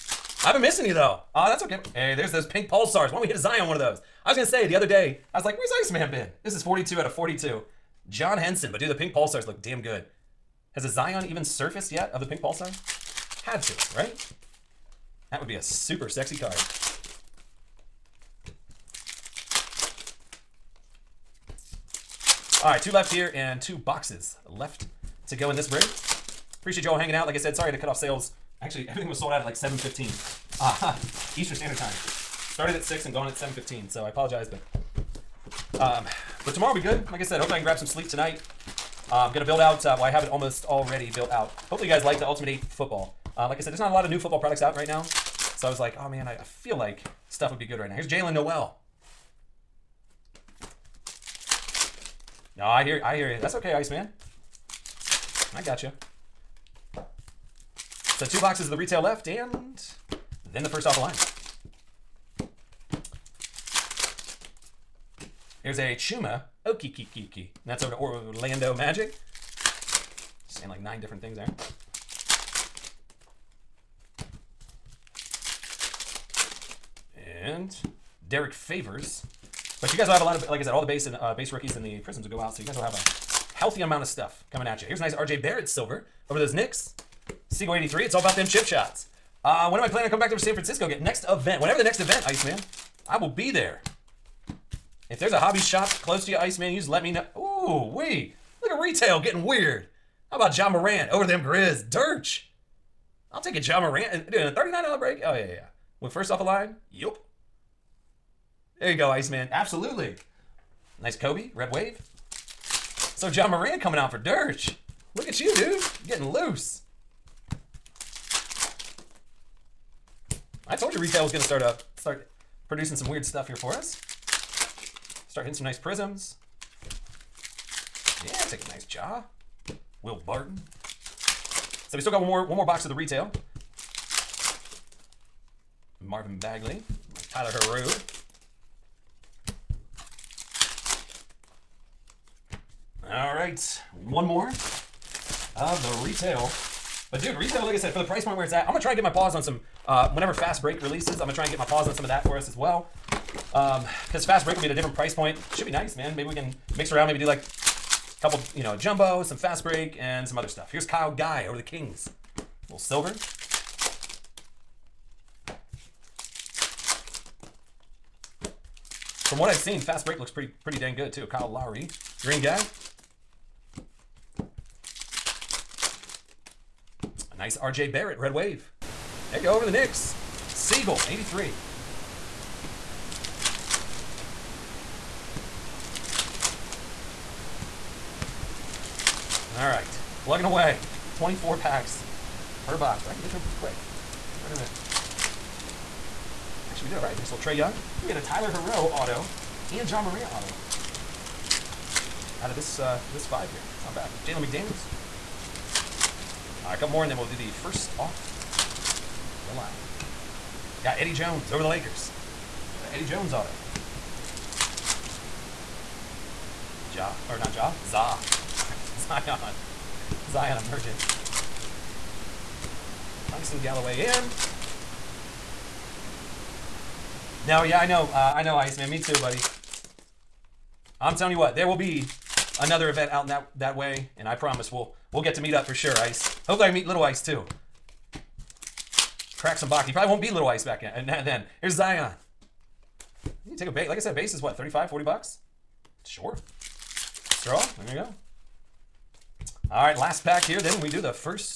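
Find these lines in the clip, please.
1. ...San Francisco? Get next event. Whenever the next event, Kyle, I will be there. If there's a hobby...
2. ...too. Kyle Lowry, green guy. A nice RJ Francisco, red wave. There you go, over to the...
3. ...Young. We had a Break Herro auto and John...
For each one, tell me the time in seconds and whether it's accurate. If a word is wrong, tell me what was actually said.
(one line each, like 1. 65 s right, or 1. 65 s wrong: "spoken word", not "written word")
1. 90 s wrong: "Iceman", not "Kyle"
2. 171 s wrong: "Barrett", not "Francisco"
3. 197 s wrong: "Tyler", not "Break".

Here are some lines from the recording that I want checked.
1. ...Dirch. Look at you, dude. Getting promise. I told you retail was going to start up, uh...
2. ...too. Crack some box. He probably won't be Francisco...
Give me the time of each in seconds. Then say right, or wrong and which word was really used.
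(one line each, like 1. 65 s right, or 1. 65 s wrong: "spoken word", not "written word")
1. 114 s wrong: "loose", not "promise"
2. 237 s wrong: "Little", not "Francisco".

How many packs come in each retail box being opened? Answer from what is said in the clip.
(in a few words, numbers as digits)
24.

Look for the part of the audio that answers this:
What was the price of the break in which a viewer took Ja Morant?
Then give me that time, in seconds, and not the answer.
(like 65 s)
104 s.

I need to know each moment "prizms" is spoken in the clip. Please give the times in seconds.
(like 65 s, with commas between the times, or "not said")
81 s, 125 s.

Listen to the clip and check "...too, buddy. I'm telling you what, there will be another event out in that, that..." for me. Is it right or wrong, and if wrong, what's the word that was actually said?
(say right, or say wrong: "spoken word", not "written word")
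right.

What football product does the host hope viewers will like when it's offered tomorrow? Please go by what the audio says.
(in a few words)
Ultimate 8.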